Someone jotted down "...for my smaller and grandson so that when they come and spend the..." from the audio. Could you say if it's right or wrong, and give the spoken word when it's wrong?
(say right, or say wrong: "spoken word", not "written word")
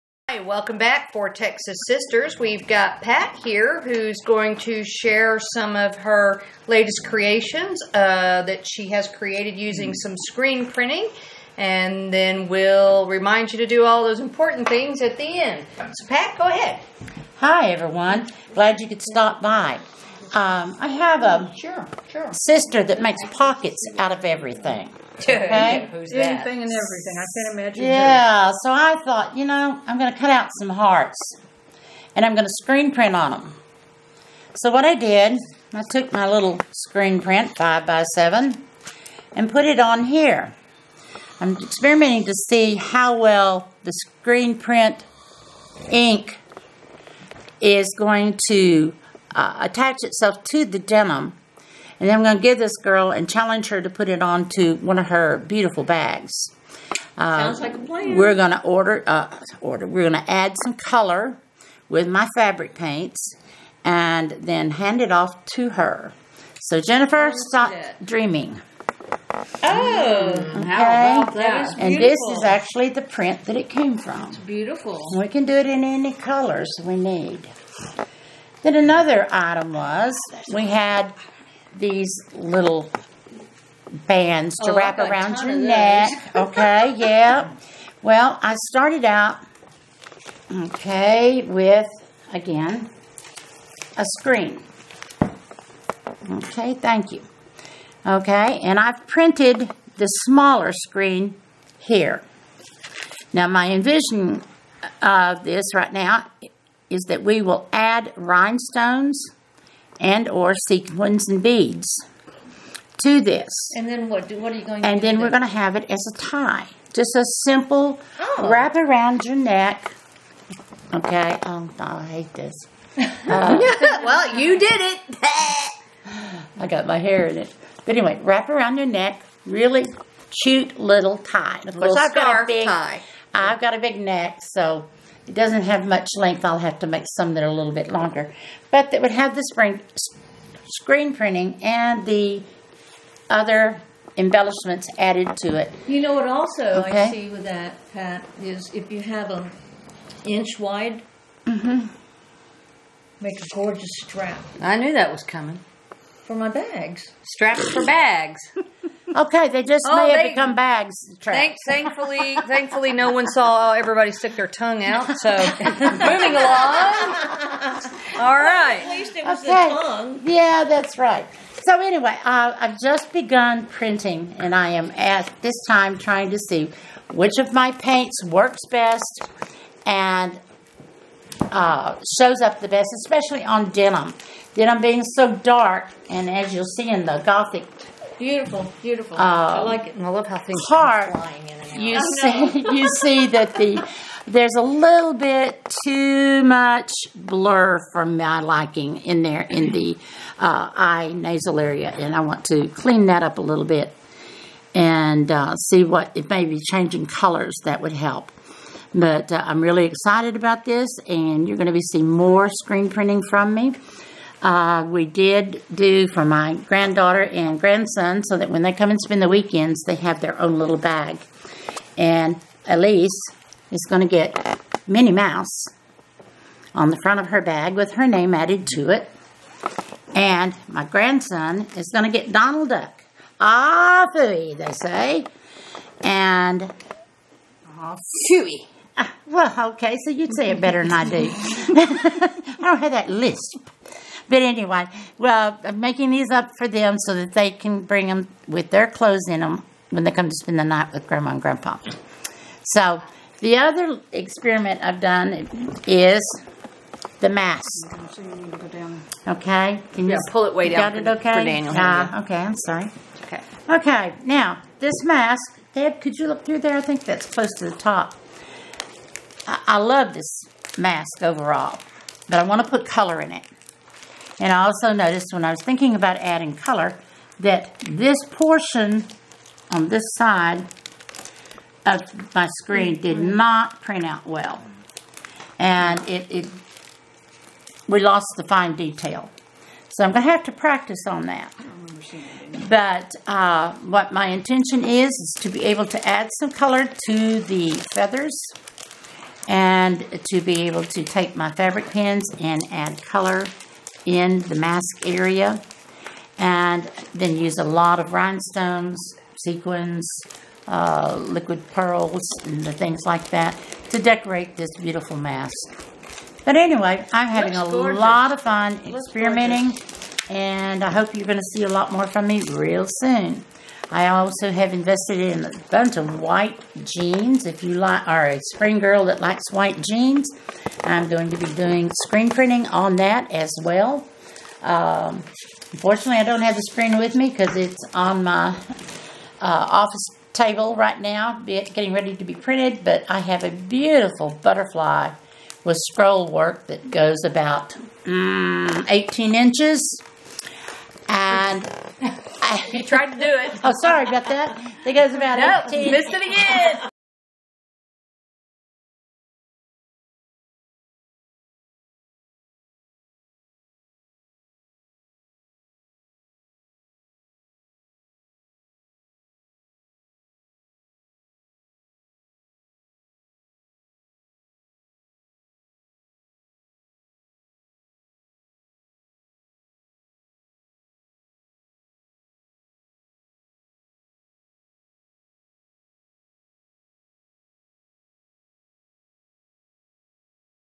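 wrong: "granddaughter", not "smaller".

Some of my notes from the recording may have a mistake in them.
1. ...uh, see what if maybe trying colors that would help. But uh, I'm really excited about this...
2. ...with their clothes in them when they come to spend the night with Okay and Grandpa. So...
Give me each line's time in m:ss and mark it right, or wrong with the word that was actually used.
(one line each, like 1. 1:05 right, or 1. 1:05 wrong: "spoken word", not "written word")
1. 3:25 wrong: "changing", not "trying"
2. 4:08 wrong: "Grandma", not "Okay".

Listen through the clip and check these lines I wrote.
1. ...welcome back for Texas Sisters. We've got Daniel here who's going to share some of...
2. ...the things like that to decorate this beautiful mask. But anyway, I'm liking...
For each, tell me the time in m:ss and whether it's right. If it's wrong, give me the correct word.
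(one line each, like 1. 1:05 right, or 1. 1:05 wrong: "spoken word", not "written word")
1. 0:00 wrong: "Pat", not "Daniel"
2. 5:12 wrong: "having", not "liking".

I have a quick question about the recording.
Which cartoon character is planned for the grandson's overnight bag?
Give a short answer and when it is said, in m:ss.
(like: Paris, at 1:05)
Donald Duck, at 3:52.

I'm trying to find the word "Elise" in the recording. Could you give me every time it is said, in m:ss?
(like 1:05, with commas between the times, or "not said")
3:42.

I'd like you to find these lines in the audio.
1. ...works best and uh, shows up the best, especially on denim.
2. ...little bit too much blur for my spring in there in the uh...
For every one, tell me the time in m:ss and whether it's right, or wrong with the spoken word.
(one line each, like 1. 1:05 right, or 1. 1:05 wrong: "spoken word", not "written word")
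1. 2:58 right
2. 3:14 wrong: "liking", not "spring".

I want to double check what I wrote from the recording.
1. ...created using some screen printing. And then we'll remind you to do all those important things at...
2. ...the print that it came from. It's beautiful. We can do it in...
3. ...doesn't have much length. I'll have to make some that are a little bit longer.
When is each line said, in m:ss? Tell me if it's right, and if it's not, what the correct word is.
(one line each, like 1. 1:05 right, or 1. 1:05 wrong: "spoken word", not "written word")
1. 0:09 right
2. 1:12 right
3. 2:15 right.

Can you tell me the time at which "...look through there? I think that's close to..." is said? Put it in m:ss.
4:26.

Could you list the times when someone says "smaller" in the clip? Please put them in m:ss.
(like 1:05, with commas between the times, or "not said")
1:40.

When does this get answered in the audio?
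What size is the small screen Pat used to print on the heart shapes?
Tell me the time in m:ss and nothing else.
0:37.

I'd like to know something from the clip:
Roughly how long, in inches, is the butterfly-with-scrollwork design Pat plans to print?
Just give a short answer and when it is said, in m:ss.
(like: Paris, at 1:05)
18 inches, at 5:48.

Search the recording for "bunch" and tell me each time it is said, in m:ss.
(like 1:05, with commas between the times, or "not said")
5:25.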